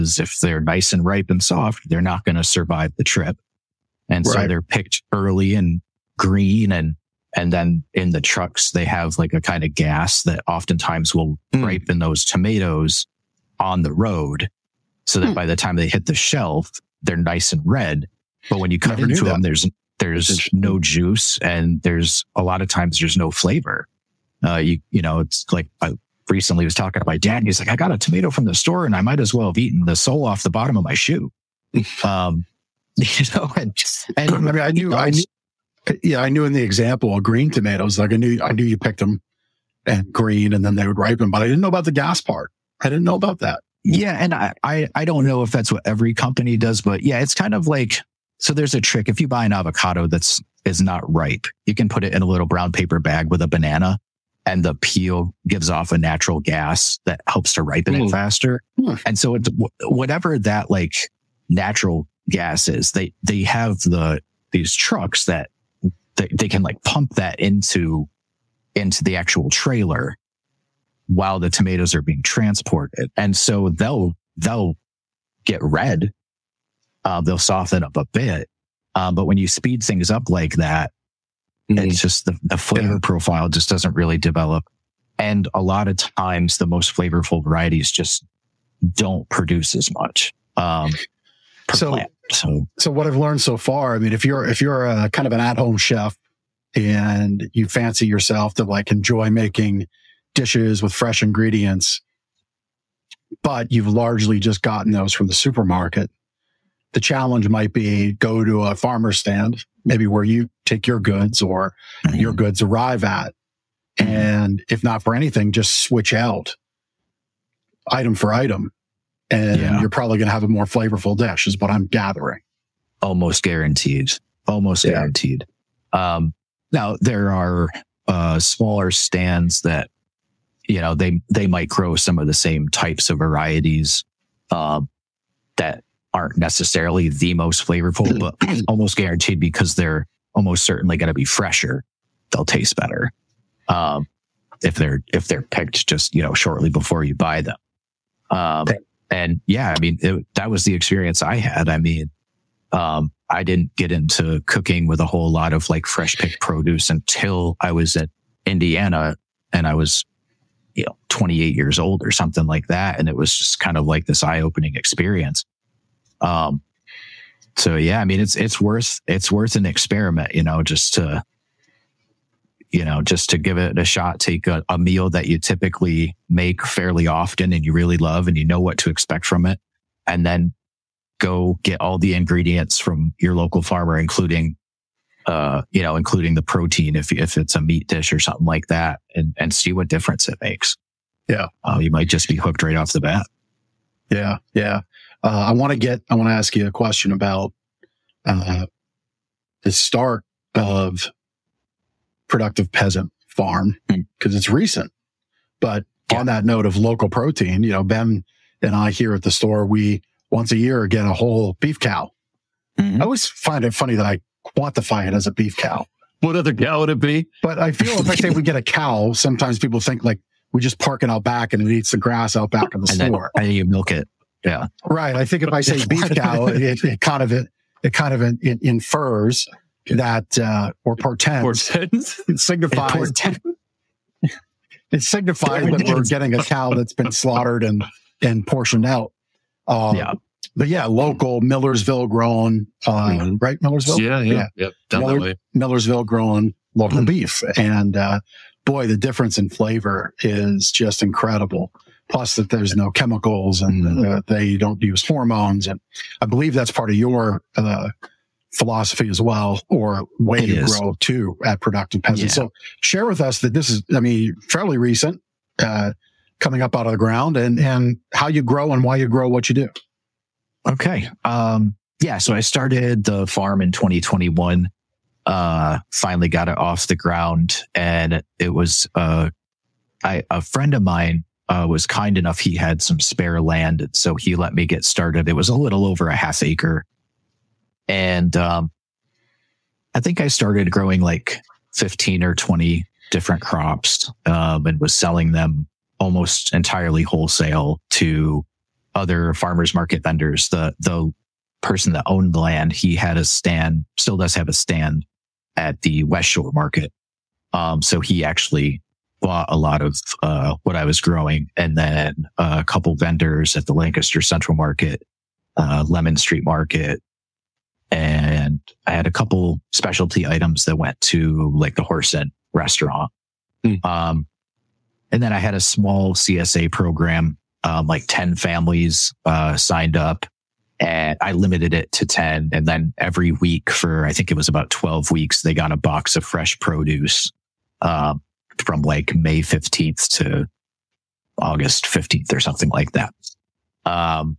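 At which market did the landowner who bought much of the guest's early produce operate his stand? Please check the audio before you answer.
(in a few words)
West Shore market.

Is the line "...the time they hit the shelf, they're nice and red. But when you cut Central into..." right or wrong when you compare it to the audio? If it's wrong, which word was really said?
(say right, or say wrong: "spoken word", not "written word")
wrong: "Never", not "Central".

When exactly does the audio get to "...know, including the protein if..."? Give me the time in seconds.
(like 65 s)
185 s.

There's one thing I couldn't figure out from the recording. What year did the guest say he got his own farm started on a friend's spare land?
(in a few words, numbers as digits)
2021.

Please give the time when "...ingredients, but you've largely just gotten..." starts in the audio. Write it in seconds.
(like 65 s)
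101 s.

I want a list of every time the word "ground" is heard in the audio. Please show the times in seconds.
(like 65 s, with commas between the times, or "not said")
266 s, 276 s.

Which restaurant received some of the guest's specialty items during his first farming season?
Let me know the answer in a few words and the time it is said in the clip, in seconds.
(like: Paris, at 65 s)
Horse Inn, at 321 s.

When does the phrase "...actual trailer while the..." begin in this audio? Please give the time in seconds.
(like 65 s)
69 s.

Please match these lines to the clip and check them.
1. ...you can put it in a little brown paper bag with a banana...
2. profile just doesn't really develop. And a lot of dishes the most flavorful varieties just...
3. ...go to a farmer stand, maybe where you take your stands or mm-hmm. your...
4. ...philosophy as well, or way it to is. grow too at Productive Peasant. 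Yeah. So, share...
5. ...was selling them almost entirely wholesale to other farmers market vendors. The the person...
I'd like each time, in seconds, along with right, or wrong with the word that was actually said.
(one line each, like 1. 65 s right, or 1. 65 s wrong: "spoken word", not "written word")
1. 51 s right
2. 83 s wrong: "times", not "dishes"
3. 108 s wrong: "goods", not "stands"
4. 258 s right
5. 294 s right.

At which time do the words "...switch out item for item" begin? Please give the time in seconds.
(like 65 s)
115 s.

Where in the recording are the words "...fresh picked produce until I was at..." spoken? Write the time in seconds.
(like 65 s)
155 s.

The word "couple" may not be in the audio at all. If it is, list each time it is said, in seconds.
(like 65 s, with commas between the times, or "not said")
312 s, 319 s.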